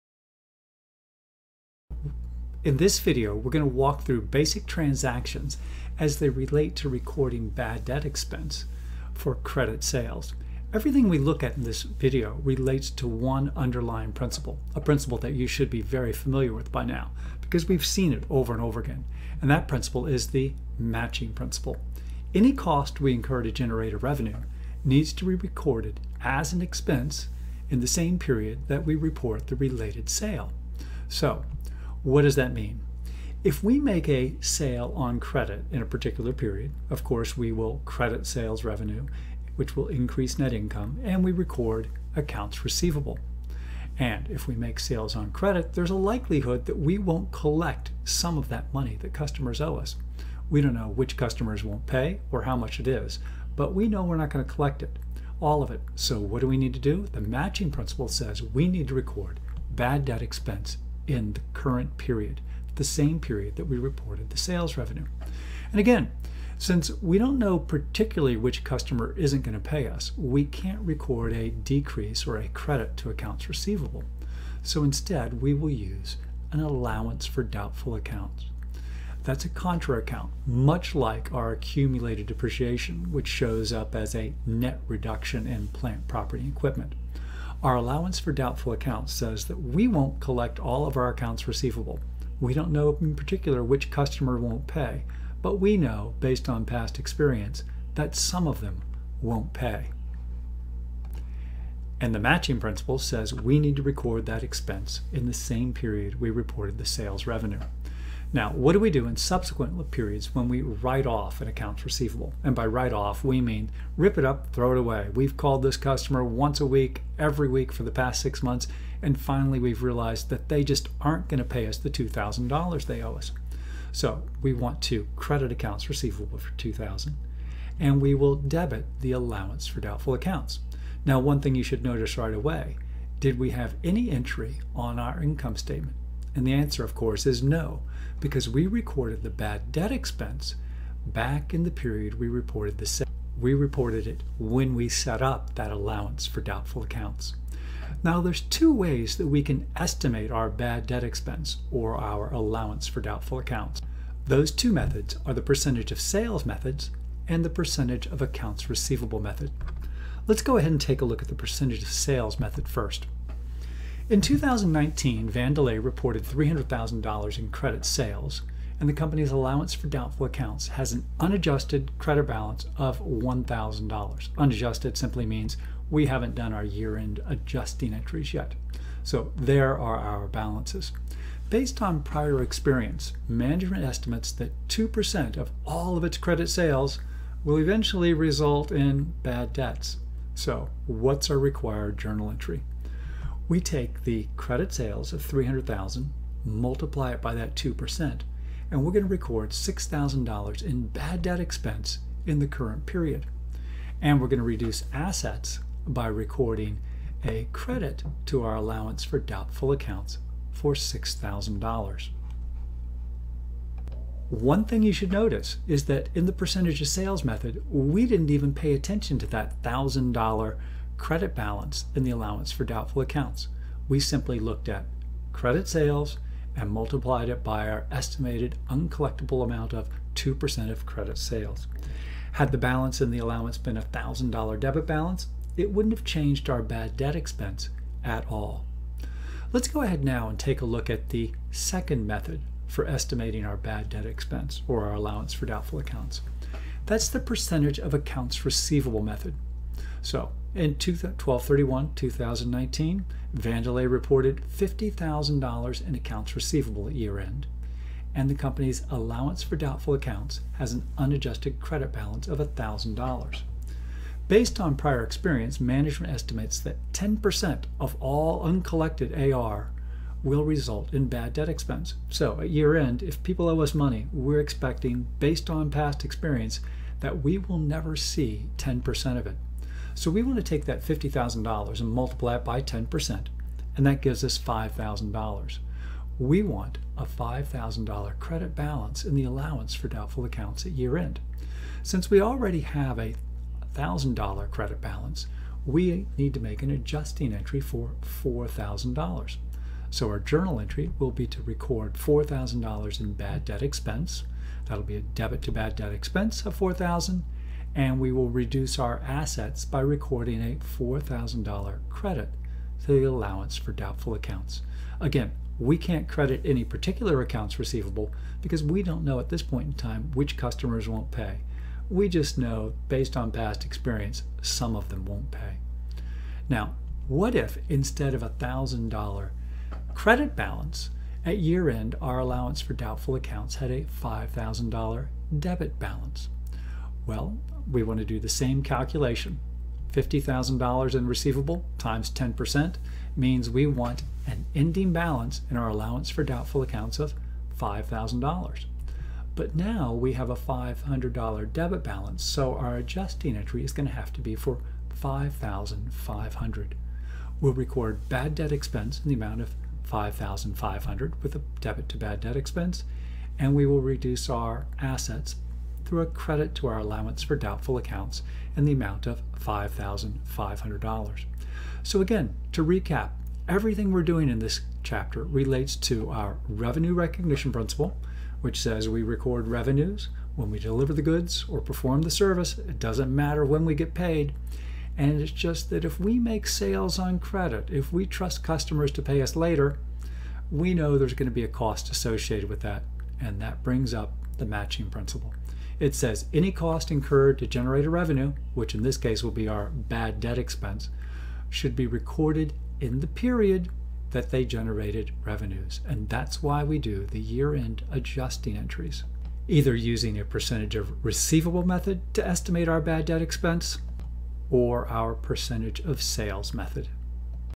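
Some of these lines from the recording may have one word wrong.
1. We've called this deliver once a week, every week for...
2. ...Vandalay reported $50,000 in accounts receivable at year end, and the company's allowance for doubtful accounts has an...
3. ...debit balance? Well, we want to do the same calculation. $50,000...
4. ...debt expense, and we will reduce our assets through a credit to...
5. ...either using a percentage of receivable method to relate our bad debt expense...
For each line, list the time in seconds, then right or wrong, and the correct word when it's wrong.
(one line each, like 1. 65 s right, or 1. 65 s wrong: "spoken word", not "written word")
1. 115 s wrong: "customer", not "deliver"
2. 253 s right
3. 335 s right
4. 362 s right
5. 409 s wrong: "estimate", not "relate".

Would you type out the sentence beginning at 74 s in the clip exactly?
So instead, we will use an allowance for doubtful accounts.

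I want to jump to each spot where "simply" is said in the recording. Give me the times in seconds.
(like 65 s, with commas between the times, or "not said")
174 s, 223 s.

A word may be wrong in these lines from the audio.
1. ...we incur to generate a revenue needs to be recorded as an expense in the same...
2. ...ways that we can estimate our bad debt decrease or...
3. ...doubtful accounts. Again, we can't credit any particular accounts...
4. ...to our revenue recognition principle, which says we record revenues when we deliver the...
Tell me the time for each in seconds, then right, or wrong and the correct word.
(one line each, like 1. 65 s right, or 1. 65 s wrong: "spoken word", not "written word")
1. 23 s right
2. 148 s wrong: "expense", not "decrease"
3. 313 s right
4. 375 s right.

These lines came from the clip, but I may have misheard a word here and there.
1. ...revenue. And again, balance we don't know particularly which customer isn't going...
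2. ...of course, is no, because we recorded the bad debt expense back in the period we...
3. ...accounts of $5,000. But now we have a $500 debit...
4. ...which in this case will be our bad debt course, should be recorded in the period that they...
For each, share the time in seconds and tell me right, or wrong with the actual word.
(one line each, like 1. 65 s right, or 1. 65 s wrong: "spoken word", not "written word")
1. 64 s wrong: "since", not "balance"
2. 136 s right
3. 346 s right
4. 398 s wrong: "expense", not "course".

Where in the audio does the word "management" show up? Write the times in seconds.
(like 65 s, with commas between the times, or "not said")
183 s, 265 s.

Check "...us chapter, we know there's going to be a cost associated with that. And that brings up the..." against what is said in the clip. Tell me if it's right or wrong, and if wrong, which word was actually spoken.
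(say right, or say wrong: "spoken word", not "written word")
wrong: "later", not "chapter".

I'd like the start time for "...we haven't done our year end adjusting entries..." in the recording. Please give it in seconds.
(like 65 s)
175 s.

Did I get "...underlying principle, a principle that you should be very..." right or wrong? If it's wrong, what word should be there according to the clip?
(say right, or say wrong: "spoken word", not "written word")
right.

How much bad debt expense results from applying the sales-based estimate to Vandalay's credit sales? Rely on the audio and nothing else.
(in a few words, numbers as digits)
$6,000.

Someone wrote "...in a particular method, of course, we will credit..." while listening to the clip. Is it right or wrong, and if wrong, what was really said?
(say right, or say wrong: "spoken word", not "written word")
wrong: "period", not "method".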